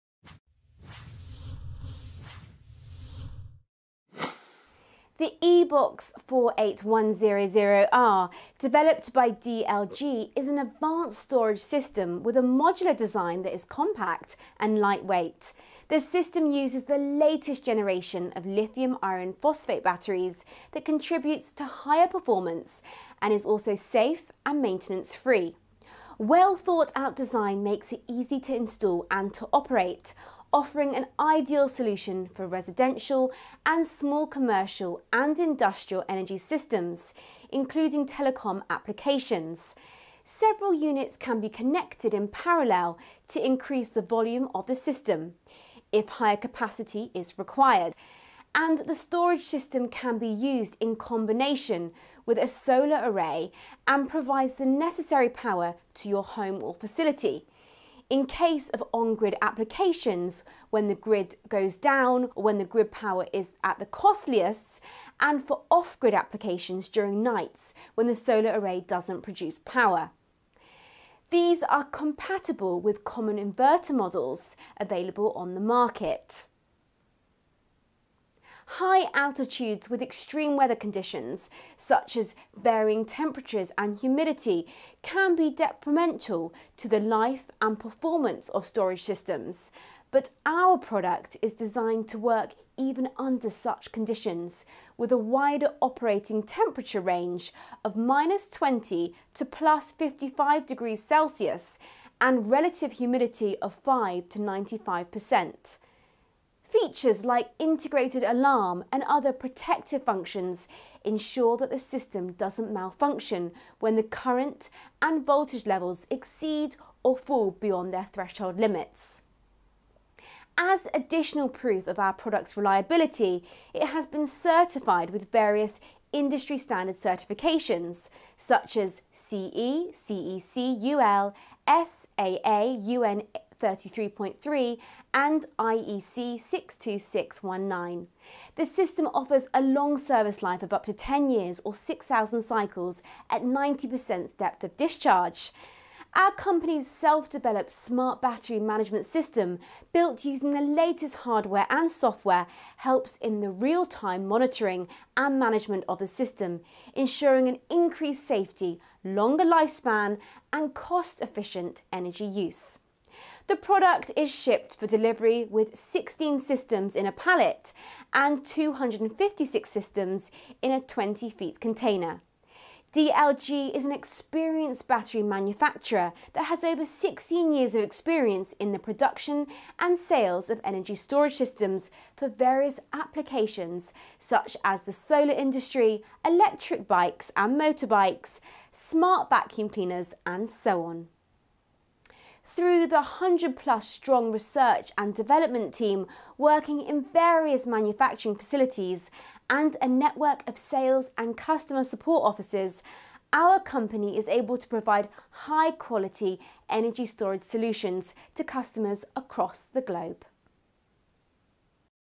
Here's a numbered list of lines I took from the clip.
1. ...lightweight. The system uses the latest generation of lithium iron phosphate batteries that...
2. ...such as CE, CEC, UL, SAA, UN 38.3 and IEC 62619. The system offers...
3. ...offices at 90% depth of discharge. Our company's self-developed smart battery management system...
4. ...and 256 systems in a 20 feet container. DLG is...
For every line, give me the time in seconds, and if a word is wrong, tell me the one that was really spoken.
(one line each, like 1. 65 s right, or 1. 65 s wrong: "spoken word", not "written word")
1. 14 s right
2. 128 s right
3. 142 s wrong: "cycles", not "offices"
4. 168 s right.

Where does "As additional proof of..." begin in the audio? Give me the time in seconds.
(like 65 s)
120 s.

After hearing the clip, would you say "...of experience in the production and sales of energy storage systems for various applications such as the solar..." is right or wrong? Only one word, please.
right.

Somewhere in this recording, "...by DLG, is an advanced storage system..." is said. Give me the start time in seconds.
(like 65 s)
9 s.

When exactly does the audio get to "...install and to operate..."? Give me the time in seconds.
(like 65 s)
28 s.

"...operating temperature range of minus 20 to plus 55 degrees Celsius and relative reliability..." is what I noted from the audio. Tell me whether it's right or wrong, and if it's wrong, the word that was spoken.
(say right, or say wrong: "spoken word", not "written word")
wrong: "humidity", not "reliability".